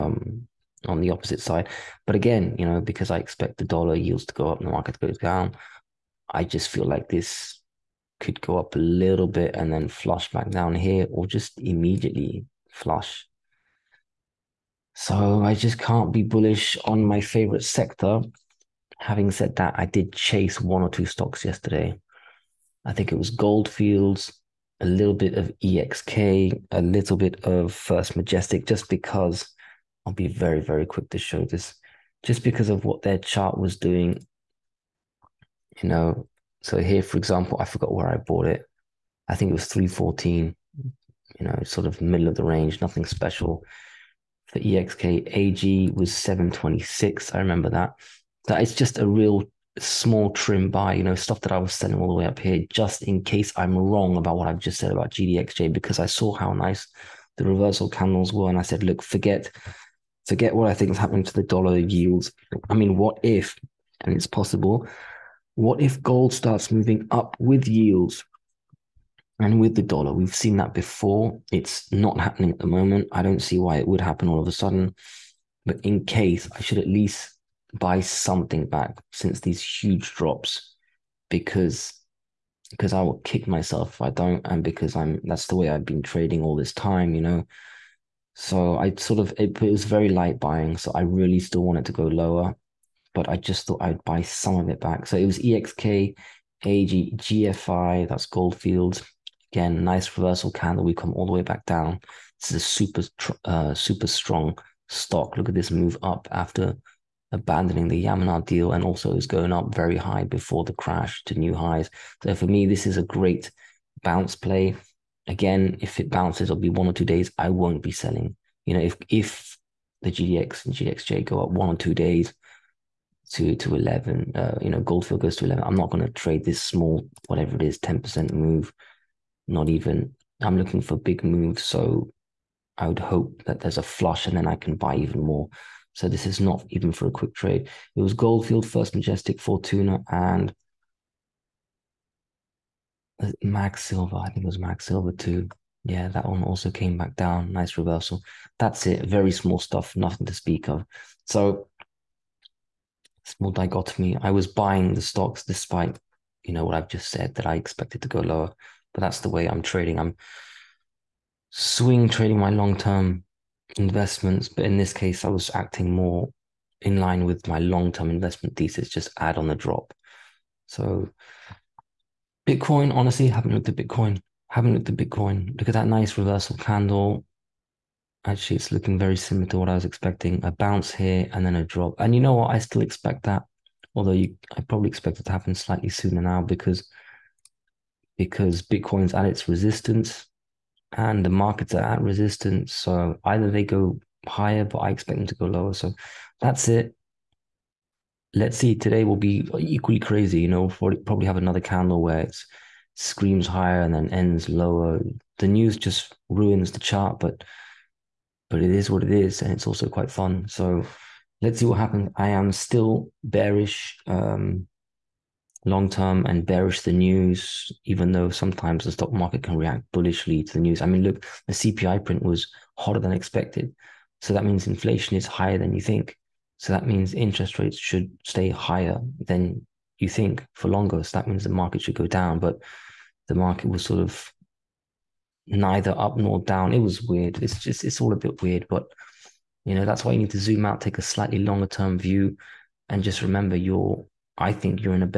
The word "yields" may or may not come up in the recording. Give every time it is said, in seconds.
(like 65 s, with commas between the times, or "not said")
3 s, 61 s, 67 s.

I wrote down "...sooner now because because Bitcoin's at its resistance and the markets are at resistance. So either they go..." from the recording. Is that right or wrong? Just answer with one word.
right.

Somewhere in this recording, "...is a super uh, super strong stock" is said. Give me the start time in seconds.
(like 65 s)
102 s.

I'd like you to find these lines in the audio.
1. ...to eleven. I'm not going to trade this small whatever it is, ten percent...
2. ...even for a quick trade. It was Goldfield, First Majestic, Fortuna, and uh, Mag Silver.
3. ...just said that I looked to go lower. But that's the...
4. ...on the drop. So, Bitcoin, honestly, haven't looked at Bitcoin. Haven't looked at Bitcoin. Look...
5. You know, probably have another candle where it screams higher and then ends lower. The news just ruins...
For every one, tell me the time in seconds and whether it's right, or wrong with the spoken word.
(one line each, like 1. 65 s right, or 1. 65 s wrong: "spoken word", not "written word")
1. 125 s right
2. 136 s right
3. 156 s wrong: "expected", not "looked"
4. 169 s right
5. 200 s right.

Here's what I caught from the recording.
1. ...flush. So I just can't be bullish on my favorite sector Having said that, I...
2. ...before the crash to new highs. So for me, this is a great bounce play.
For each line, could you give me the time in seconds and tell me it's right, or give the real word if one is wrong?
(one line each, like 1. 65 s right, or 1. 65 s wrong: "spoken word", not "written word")
1. 12 s right
2. 110 s right.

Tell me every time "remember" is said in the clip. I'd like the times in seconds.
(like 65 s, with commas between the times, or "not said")
47 s, 243 s.